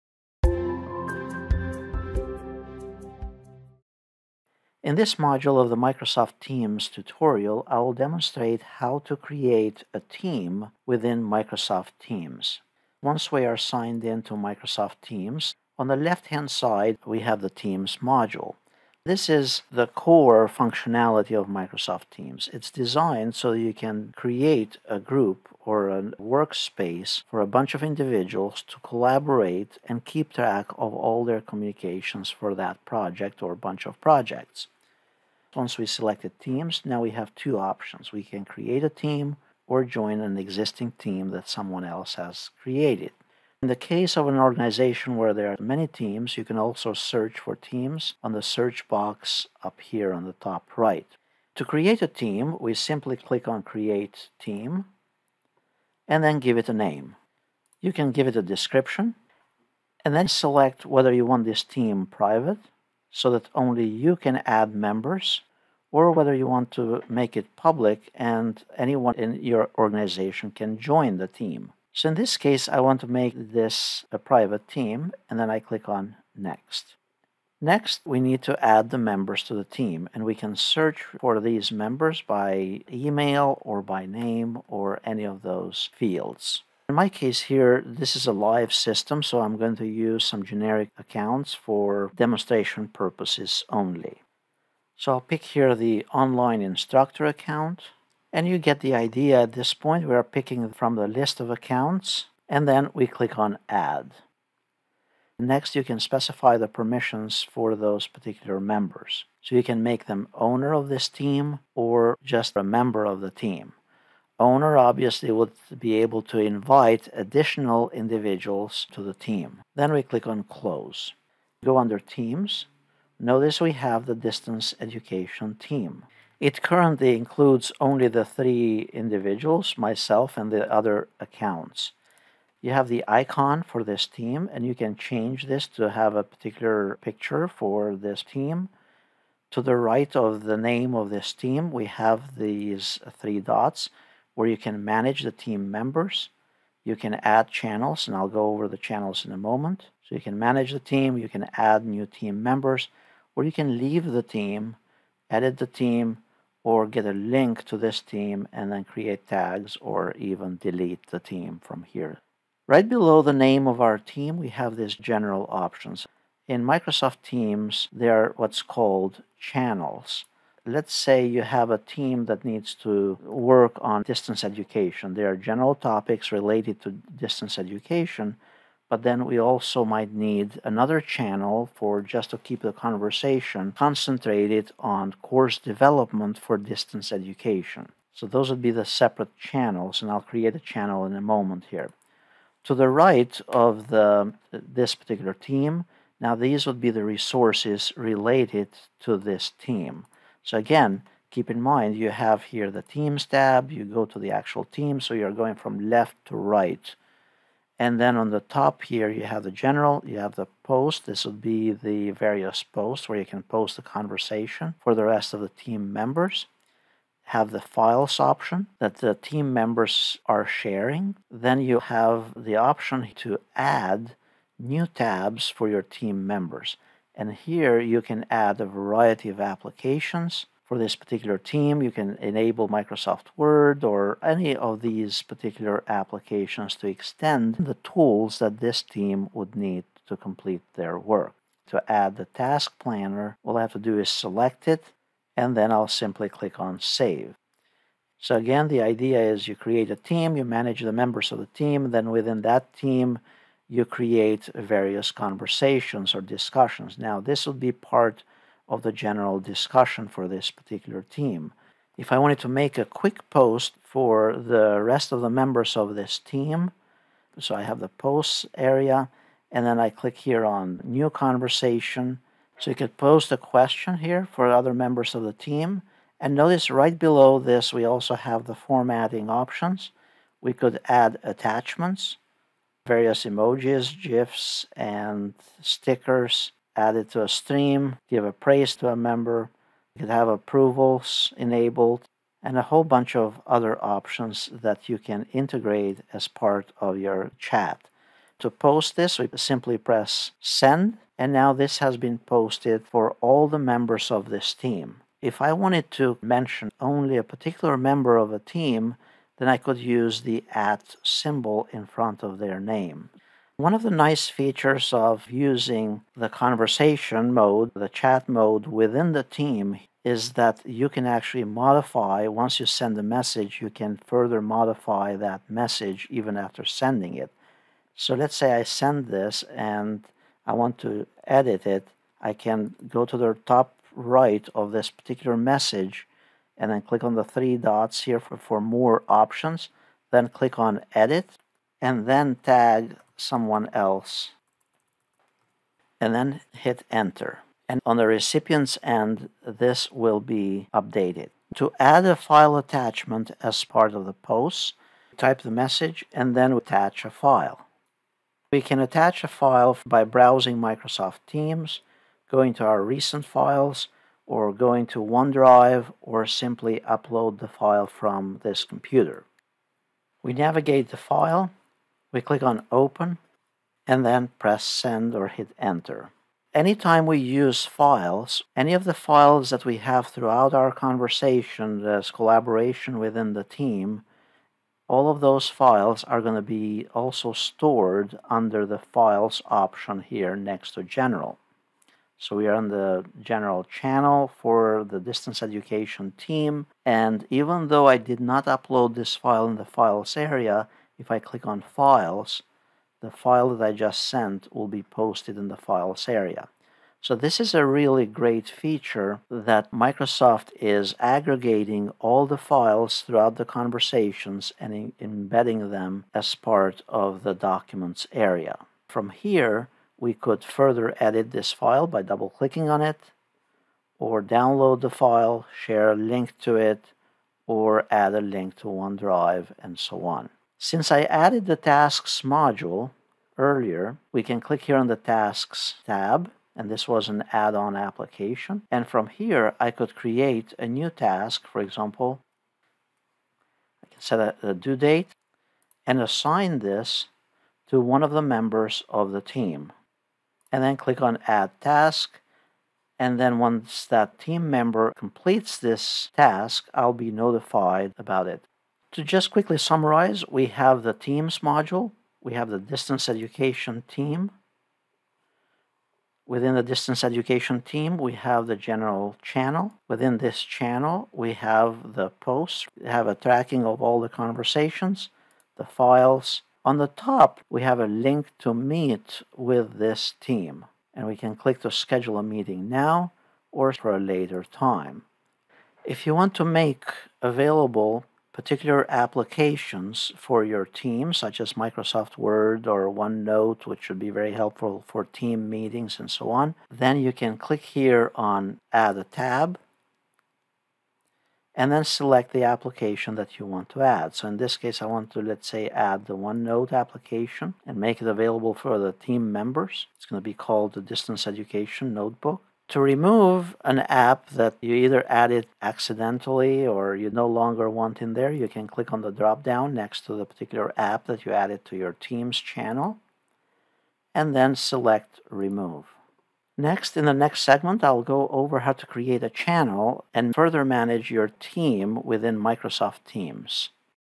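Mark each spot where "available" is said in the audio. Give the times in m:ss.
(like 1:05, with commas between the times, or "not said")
8:07, 8:28.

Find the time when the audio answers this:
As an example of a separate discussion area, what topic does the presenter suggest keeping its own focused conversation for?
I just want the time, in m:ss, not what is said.
3:05.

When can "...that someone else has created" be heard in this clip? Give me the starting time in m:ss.
0:41.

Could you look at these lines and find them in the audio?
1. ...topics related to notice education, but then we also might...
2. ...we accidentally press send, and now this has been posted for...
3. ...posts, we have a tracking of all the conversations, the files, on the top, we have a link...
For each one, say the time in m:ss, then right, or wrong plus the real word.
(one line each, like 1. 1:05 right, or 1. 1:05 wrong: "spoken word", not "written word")
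1. 2:55 wrong: "distance", not "notice"
2. 4:59 wrong: "simply", not "accidentally"
3. 7:52 right.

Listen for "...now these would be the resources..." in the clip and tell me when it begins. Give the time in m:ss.
3:16.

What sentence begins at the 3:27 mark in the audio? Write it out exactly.
And then on the top here, you have the general, you have the post.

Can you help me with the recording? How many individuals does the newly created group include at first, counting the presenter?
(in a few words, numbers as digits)
3.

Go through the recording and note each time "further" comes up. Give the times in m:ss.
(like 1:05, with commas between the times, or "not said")
5:24, 7:00, 8:50.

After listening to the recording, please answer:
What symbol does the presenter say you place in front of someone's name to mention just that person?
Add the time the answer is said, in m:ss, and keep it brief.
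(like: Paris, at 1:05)
@ (at symbol), at 5:10.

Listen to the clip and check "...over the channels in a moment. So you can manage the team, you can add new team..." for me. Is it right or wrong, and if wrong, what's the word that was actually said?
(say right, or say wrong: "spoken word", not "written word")
right.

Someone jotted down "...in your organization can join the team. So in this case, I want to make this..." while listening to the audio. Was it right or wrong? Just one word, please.
right.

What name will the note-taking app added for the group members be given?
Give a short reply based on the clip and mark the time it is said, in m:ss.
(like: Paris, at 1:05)
Distance Education Notebook, at 8:30.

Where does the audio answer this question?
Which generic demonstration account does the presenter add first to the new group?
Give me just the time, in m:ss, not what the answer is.
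1:36.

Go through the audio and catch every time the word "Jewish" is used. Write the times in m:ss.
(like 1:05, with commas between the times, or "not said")
not said.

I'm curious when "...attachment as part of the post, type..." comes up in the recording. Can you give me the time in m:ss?
5:52.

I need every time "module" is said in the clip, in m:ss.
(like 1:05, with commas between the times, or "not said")
0:05, 0:17, 7:12, 7:41.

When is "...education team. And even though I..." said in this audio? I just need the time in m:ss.
6:35.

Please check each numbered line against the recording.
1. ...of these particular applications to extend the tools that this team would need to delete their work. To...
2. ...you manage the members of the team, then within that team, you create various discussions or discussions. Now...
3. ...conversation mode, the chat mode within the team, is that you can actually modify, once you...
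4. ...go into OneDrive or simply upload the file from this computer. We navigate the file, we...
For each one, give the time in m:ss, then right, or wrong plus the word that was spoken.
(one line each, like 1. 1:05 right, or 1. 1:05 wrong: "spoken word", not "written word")
1. 3:54 wrong: "complete", not "delete"
2. 4:10 wrong: "conversations", not "discussions"
3. 5:16 right
4. 6:04 right.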